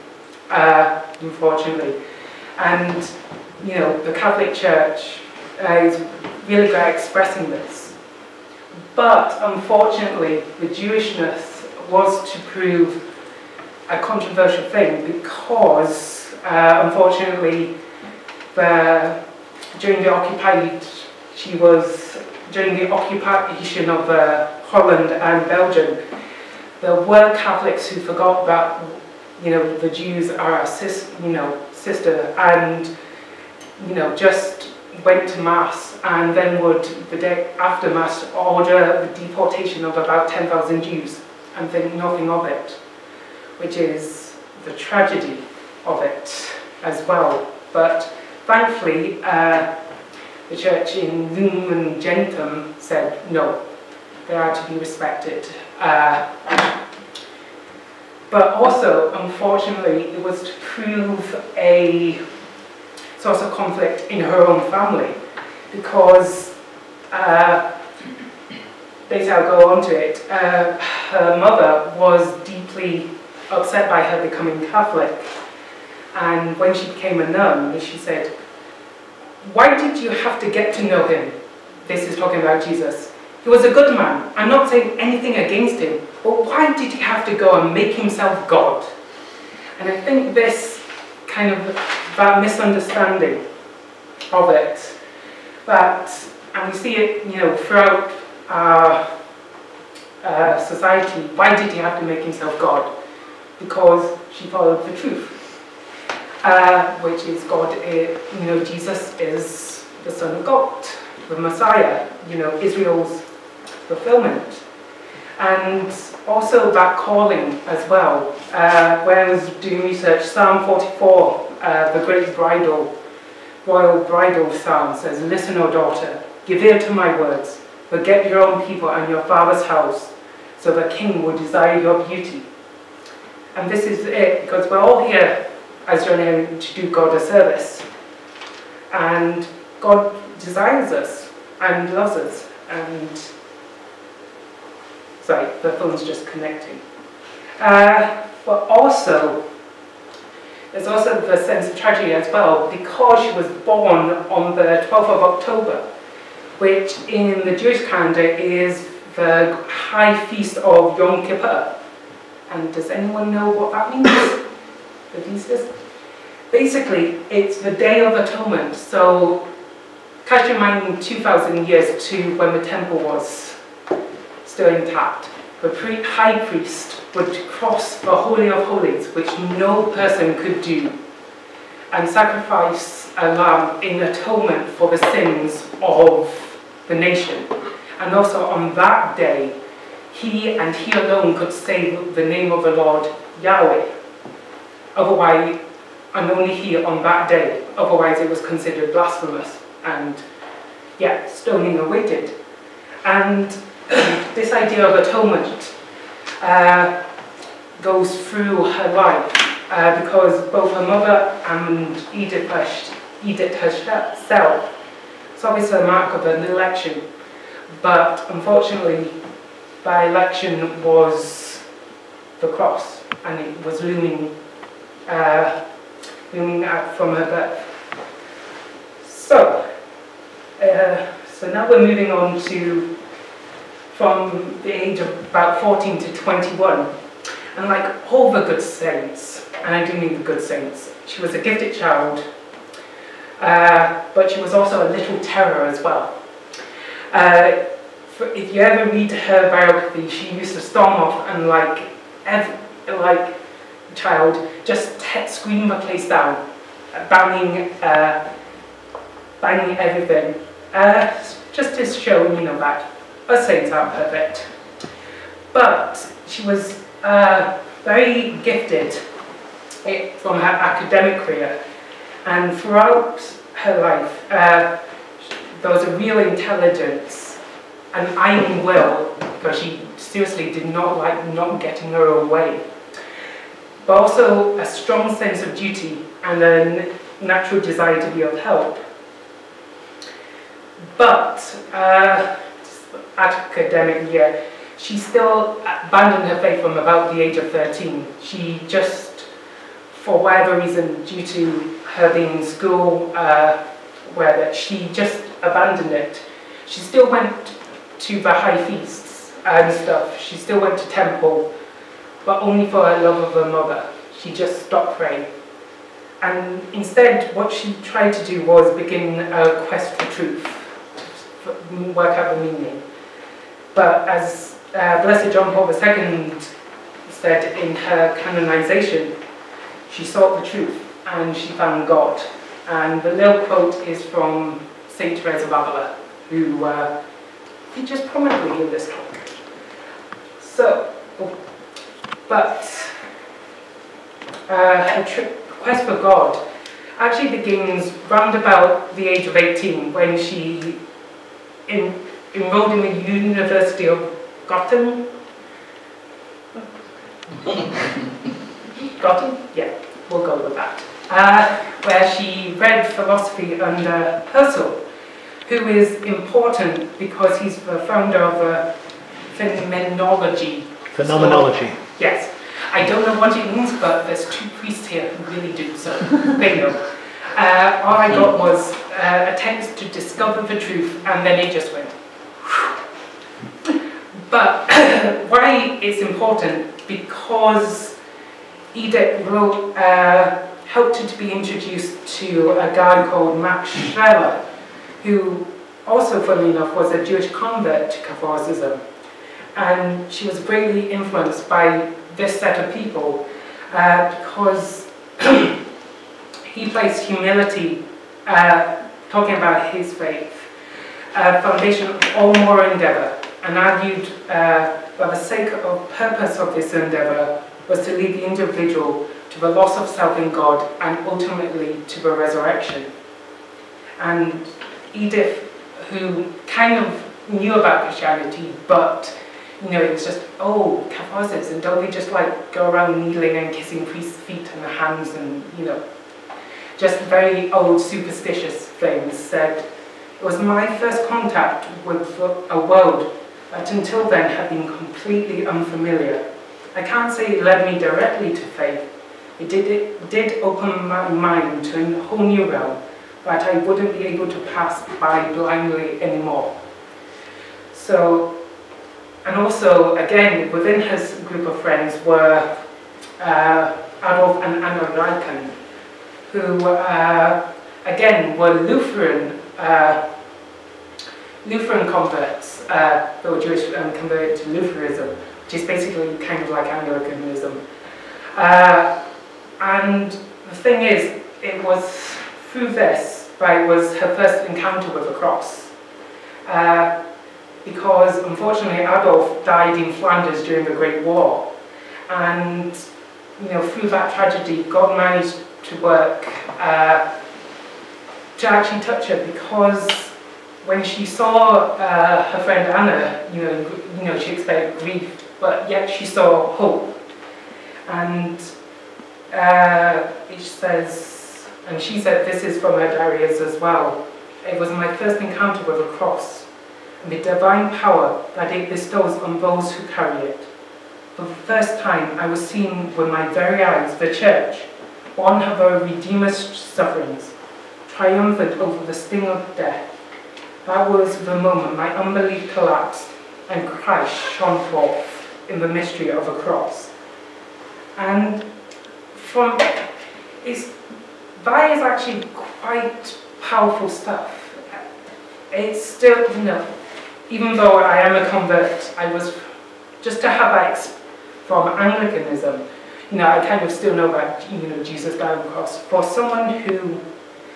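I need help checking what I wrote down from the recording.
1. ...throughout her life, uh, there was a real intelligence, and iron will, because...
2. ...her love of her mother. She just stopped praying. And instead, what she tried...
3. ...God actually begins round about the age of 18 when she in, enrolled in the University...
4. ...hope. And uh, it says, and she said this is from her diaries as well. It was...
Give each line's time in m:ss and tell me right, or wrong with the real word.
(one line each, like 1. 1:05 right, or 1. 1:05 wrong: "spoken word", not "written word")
1. 4:32 right
2. 5:12 right
3. 5:45 right
4. 8:26 right.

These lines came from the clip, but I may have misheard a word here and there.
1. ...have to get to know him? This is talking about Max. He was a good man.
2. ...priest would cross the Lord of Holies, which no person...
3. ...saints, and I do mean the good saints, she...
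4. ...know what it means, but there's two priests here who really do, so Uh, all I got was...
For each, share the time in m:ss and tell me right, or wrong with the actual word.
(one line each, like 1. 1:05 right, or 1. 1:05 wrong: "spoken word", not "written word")
1. 1:20 wrong: "Jesus", not "Max"
2. 2:56 wrong: "Holy", not "Lord"
3. 3:58 right
4. 6:13 right.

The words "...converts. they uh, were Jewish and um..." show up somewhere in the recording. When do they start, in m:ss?
7:51.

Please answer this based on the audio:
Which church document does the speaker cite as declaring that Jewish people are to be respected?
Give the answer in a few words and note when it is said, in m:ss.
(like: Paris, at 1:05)
Lumen Gentium, at 0:51.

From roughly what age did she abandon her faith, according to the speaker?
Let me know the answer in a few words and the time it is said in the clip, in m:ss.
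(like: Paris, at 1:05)
13, at 4:57.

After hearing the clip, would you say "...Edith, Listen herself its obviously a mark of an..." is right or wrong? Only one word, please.
wrong.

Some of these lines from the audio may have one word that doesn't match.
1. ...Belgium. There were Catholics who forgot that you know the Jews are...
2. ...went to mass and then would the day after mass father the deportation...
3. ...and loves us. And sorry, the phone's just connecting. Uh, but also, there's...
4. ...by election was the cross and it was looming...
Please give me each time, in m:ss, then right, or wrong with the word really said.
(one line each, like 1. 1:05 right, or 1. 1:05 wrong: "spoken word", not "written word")
1. 0:25 right
2. 0:35 wrong: "order", not "father"
3. 2:21 right
4. 3:39 right.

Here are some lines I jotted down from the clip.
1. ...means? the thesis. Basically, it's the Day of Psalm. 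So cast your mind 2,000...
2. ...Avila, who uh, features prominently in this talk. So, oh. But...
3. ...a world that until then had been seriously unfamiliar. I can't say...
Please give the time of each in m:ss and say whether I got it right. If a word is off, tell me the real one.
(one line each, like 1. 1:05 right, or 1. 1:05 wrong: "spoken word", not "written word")
1. 2:43 wrong: "Atonement", not "Psalm"
2. 5:35 right
3. 7:22 wrong: "completely", not "seriously".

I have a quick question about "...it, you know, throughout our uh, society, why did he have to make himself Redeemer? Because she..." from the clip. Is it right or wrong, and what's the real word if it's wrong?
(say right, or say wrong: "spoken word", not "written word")
wrong: "God", not "Redeemer".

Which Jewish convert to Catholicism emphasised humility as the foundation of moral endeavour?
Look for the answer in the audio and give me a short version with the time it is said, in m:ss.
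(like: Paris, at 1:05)
Max Scheler, at 6:33.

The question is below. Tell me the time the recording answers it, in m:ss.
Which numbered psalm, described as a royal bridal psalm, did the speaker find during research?
2:00.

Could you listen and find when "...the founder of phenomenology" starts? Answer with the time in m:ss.
6:07.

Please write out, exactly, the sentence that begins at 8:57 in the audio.
And from is that is actually quite powerful stuff.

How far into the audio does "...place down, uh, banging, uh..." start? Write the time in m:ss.
4:15.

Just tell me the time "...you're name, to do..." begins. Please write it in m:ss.
2:16.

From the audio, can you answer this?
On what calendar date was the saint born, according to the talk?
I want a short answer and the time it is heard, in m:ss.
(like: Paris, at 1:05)
12th of October, at 2:34.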